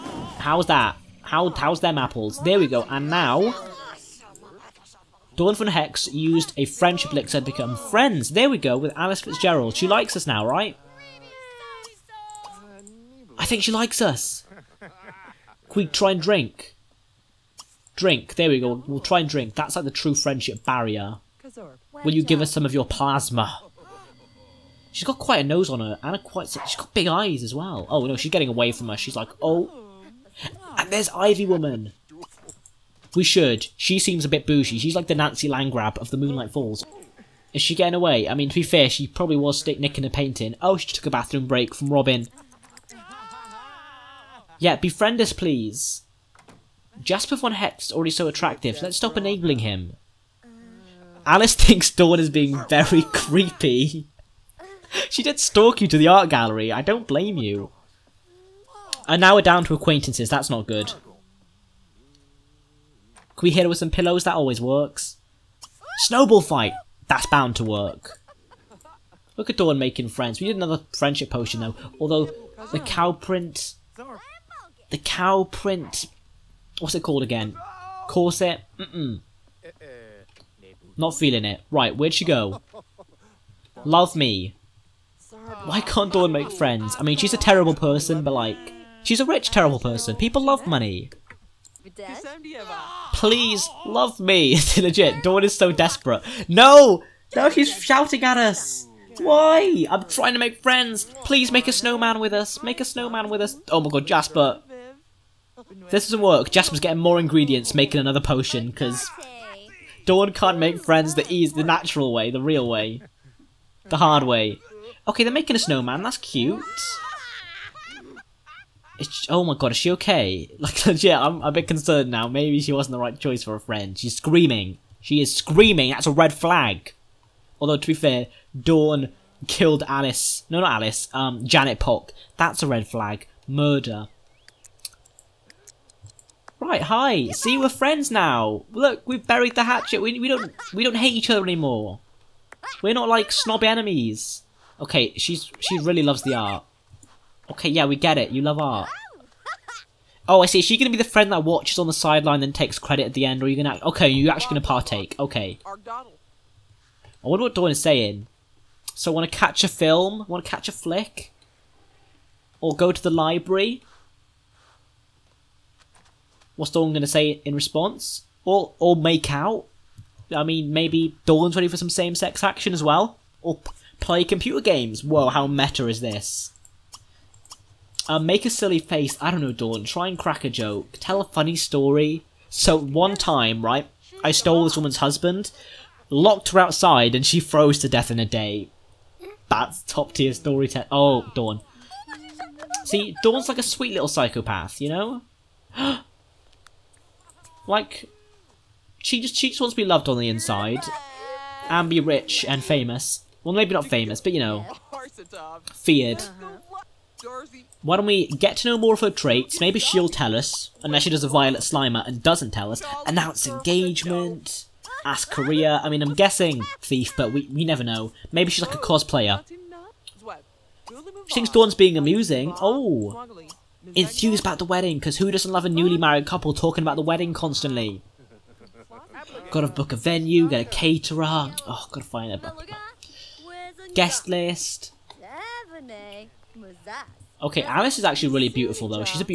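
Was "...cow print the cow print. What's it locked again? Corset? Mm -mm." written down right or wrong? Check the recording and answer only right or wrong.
wrong.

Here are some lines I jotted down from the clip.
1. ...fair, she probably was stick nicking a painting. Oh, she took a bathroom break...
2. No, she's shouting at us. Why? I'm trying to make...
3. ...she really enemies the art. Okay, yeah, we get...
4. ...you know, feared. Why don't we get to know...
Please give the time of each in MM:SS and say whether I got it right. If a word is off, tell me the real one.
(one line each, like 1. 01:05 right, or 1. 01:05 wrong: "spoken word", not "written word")
1. 00:38 right
2. 01:37 right
3. 02:25 wrong: "loves", not "enemies"
4. 03:24 right.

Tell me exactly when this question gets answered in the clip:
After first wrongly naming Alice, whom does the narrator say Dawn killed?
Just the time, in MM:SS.
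02:11.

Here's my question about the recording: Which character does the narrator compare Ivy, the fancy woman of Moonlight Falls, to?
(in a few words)
Nancy Landgraab.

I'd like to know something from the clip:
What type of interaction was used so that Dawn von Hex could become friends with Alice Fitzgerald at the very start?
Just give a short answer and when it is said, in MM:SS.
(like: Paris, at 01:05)
Friendship lick, at 00:06.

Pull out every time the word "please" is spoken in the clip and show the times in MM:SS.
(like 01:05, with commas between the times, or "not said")
00:45, 01:33, 01:41.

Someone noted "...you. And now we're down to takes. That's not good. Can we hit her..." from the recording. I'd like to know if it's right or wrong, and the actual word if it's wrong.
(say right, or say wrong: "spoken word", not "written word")
wrong: "acquaintances", not "takes".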